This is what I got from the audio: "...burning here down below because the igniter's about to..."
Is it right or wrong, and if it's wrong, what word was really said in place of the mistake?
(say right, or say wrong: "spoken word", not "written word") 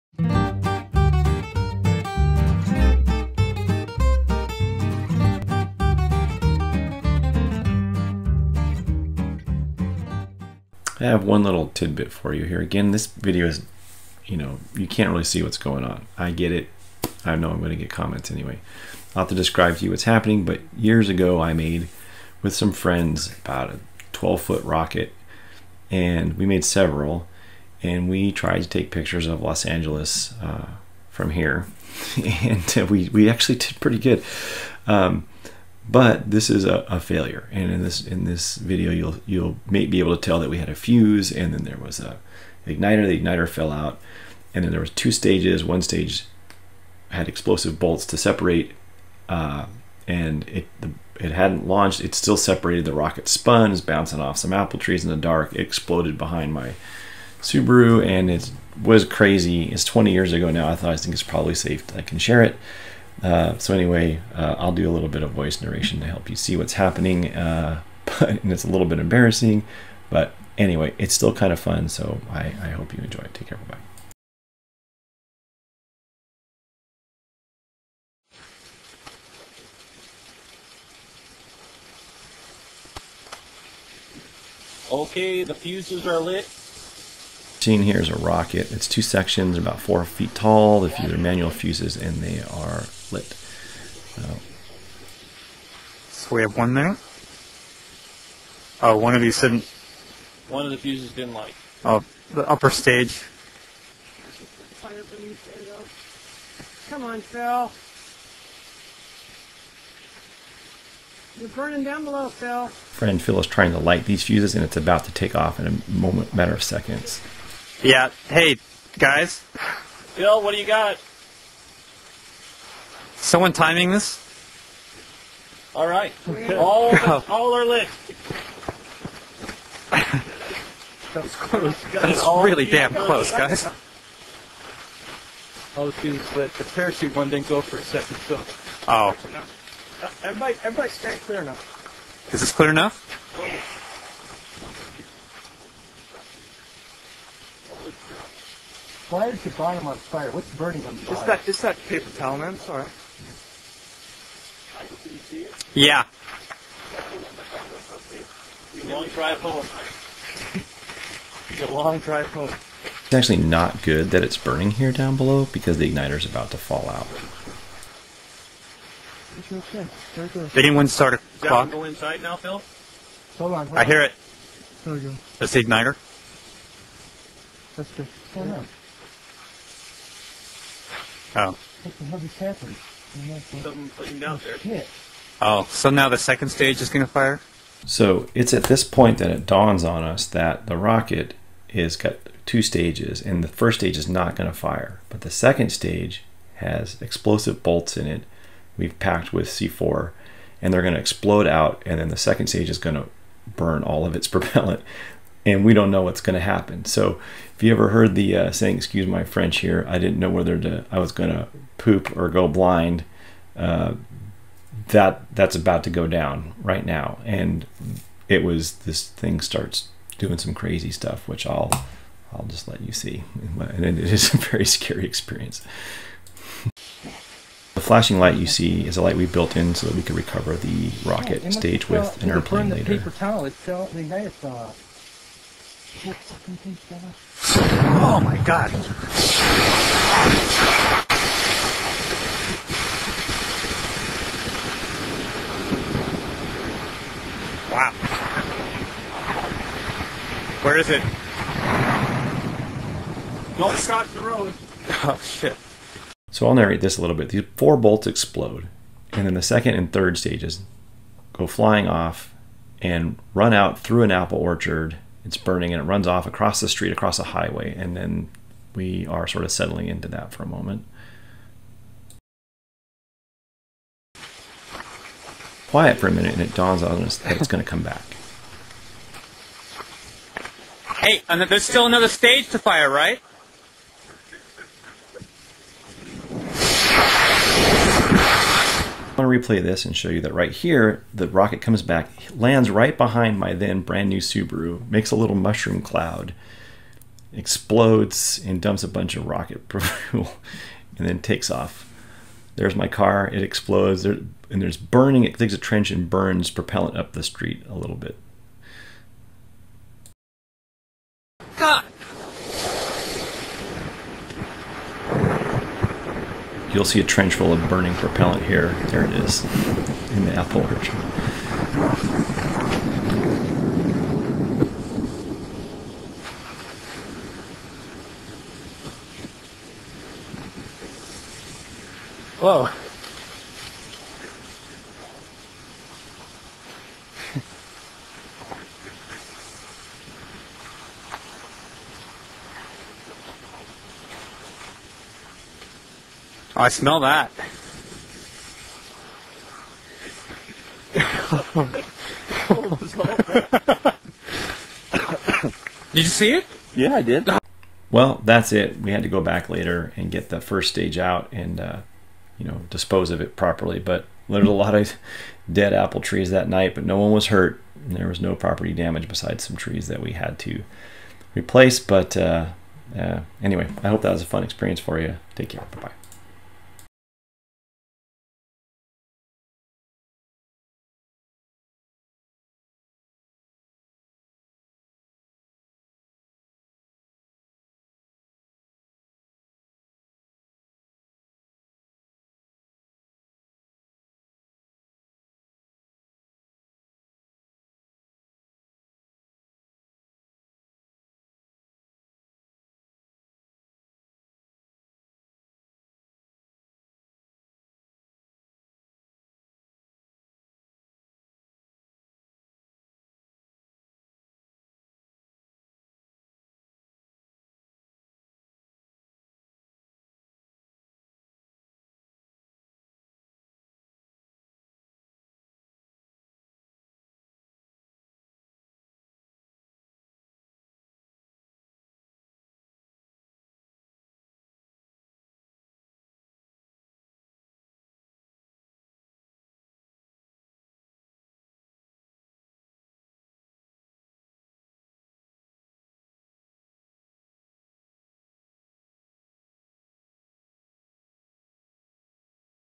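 right.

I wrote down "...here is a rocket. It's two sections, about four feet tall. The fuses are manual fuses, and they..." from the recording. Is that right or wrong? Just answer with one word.
right.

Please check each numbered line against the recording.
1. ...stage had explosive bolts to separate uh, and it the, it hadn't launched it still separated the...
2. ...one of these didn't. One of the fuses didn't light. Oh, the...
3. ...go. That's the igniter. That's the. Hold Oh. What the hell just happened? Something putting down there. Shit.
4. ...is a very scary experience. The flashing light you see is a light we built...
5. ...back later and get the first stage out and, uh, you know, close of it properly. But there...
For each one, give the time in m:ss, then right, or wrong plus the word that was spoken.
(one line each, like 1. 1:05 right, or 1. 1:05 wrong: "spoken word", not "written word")
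1. 0:45 right
2. 1:38 right
3. 2:54 right
4. 3:43 right
5. 5:59 wrong: "dispose", not "close".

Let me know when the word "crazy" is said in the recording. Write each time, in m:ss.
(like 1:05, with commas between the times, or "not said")
0:59, 3:40.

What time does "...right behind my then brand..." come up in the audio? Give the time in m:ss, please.
4:52.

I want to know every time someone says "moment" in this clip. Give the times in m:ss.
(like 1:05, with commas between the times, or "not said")
1:55, 4:30.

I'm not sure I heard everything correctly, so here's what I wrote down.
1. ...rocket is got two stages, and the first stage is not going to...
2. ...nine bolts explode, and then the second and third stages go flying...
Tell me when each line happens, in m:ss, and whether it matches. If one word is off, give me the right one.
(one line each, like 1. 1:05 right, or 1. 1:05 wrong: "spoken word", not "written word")
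1. 3:10 right
2. 4:17 wrong: "four", not "nine".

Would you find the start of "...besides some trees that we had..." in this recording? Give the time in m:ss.
6:09.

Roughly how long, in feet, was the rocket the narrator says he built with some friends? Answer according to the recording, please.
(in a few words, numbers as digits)
12 feet.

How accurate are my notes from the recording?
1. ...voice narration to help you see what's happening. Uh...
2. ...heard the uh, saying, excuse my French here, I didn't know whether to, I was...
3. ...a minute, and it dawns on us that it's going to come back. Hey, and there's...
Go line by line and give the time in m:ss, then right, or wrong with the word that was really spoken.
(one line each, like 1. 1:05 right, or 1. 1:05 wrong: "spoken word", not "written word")
1. 1:05 right
2. 3:27 right
3. 4:36 right.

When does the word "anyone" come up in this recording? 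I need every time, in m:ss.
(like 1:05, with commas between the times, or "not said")
2:50.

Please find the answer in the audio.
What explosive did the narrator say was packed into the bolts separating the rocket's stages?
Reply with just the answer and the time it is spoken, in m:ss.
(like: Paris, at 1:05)
C4, at 3:19.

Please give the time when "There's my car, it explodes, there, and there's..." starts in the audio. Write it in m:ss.
5:02.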